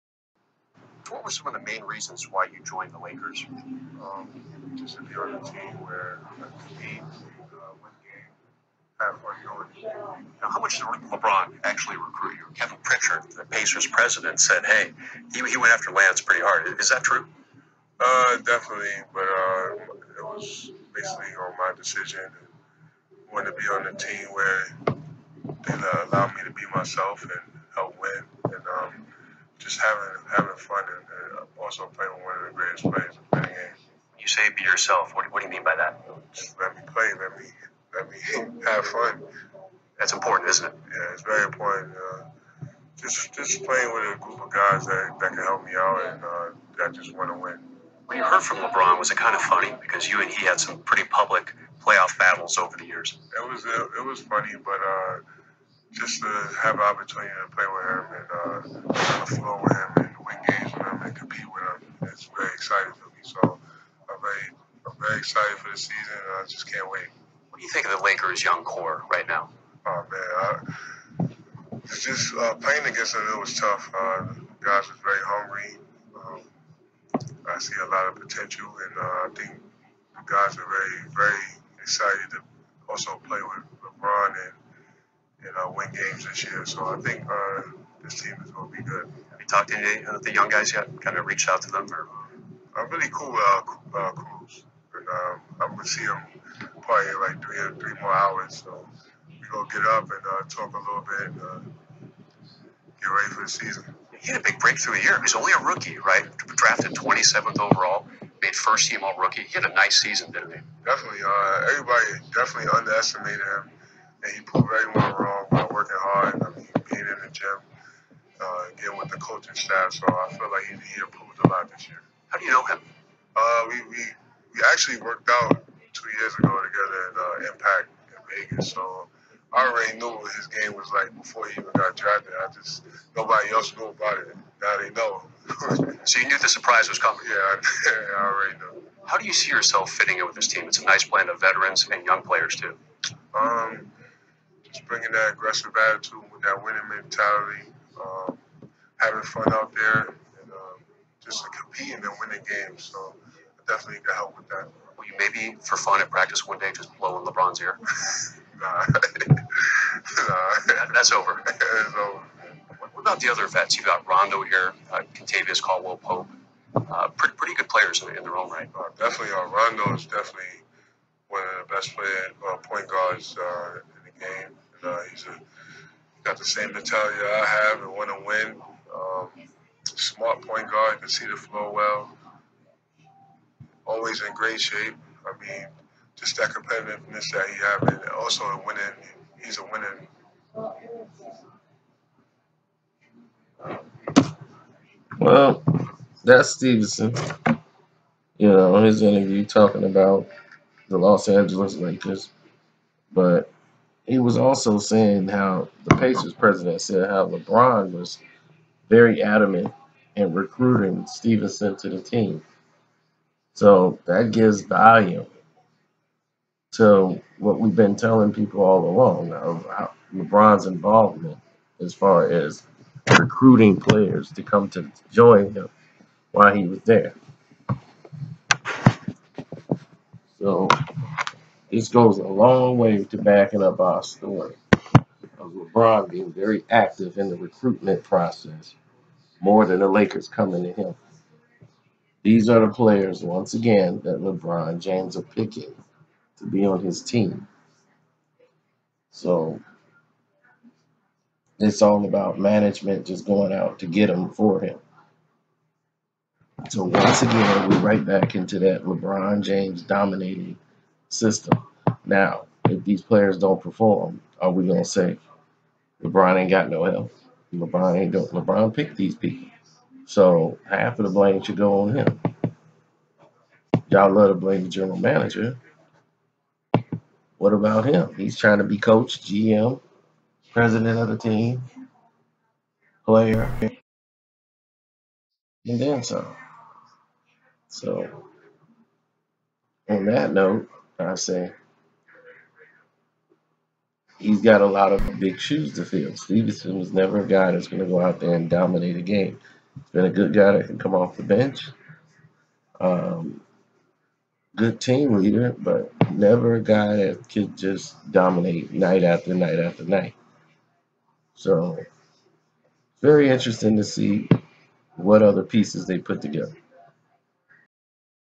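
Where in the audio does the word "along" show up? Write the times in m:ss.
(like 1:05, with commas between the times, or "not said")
3:38.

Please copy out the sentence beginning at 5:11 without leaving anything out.
So, very interesting to see what other pieces they put together.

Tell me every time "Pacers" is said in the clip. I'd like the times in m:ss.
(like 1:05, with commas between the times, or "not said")
0:13, 3:25.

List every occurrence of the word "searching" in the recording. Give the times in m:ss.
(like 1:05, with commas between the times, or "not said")
not said.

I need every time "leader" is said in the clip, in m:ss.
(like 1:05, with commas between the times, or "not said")
5:05.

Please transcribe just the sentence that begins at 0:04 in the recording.
Um, just to be on a team where we can uh, uh win game, have priority.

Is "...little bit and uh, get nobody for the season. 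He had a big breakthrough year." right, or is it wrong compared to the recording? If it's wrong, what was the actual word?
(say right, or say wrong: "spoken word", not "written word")
wrong: "ready", not "nobody".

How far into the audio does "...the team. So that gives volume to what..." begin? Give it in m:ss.
3:31.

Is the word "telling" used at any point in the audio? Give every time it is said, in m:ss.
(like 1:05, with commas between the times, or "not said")
3:37.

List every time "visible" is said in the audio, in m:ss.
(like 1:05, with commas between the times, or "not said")
not said.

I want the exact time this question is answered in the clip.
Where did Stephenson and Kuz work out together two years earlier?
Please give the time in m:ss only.
2:07.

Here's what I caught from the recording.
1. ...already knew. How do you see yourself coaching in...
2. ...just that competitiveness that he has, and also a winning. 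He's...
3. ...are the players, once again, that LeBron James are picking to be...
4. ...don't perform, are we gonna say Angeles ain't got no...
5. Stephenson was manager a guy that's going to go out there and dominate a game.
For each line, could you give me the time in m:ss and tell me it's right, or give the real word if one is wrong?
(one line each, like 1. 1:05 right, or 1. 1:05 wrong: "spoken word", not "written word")
1. 2:18 wrong: "fitting", not "coaching"
2. 3:06 right
3. 4:02 right
4. 4:23 wrong: "LeBron", not "Angeles"
5. 4:56 wrong: "never", not "manager".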